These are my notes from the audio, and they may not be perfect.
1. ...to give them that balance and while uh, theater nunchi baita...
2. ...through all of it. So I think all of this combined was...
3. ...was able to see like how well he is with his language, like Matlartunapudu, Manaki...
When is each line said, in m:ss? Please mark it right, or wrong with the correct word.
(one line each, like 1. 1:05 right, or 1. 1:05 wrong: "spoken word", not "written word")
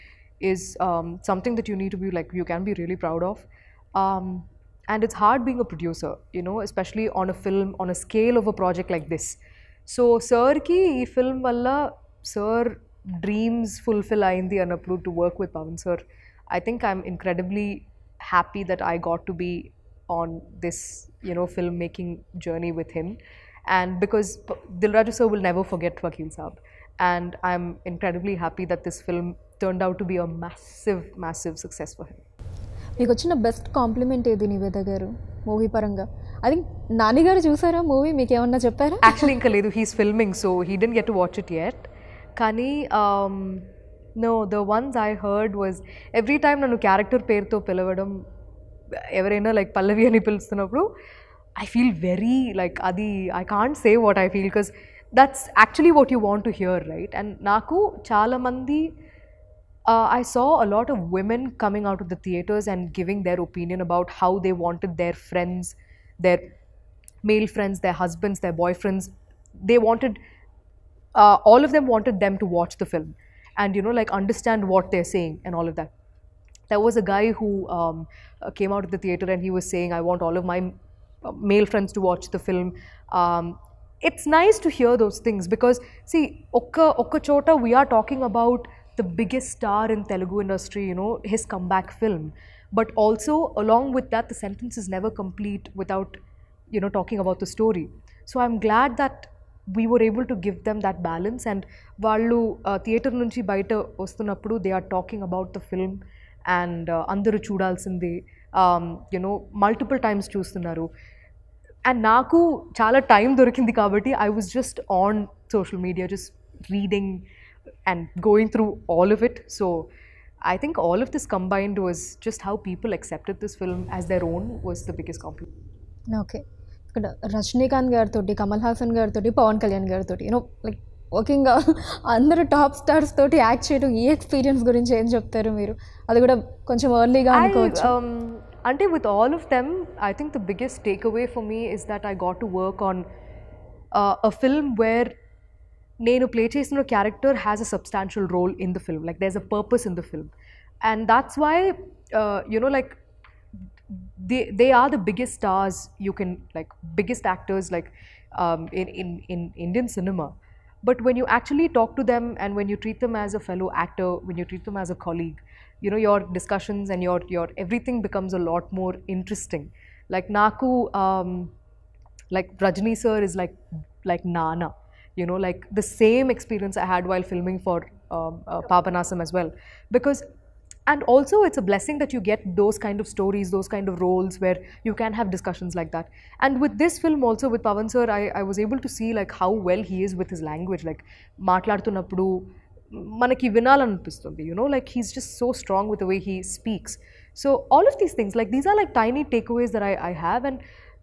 1. 1:40 right
2. 1:58 right
3. 3:08 right.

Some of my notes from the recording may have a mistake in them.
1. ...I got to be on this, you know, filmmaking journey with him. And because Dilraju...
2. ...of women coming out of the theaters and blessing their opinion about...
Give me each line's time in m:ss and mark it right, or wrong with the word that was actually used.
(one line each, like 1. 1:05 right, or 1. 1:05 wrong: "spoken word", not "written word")
1. 0:18 right
2. 1:00 wrong: "giving", not "blessing".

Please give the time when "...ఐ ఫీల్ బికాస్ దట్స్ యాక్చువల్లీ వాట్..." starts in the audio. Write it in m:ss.
0:54.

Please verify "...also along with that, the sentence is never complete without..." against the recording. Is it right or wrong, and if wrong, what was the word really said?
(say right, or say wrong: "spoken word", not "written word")
right.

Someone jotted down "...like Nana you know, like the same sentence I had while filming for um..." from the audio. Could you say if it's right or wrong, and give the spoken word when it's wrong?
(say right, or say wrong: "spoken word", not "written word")
wrong: "experience", not "sentence".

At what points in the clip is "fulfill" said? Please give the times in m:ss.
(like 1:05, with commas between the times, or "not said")
0:13.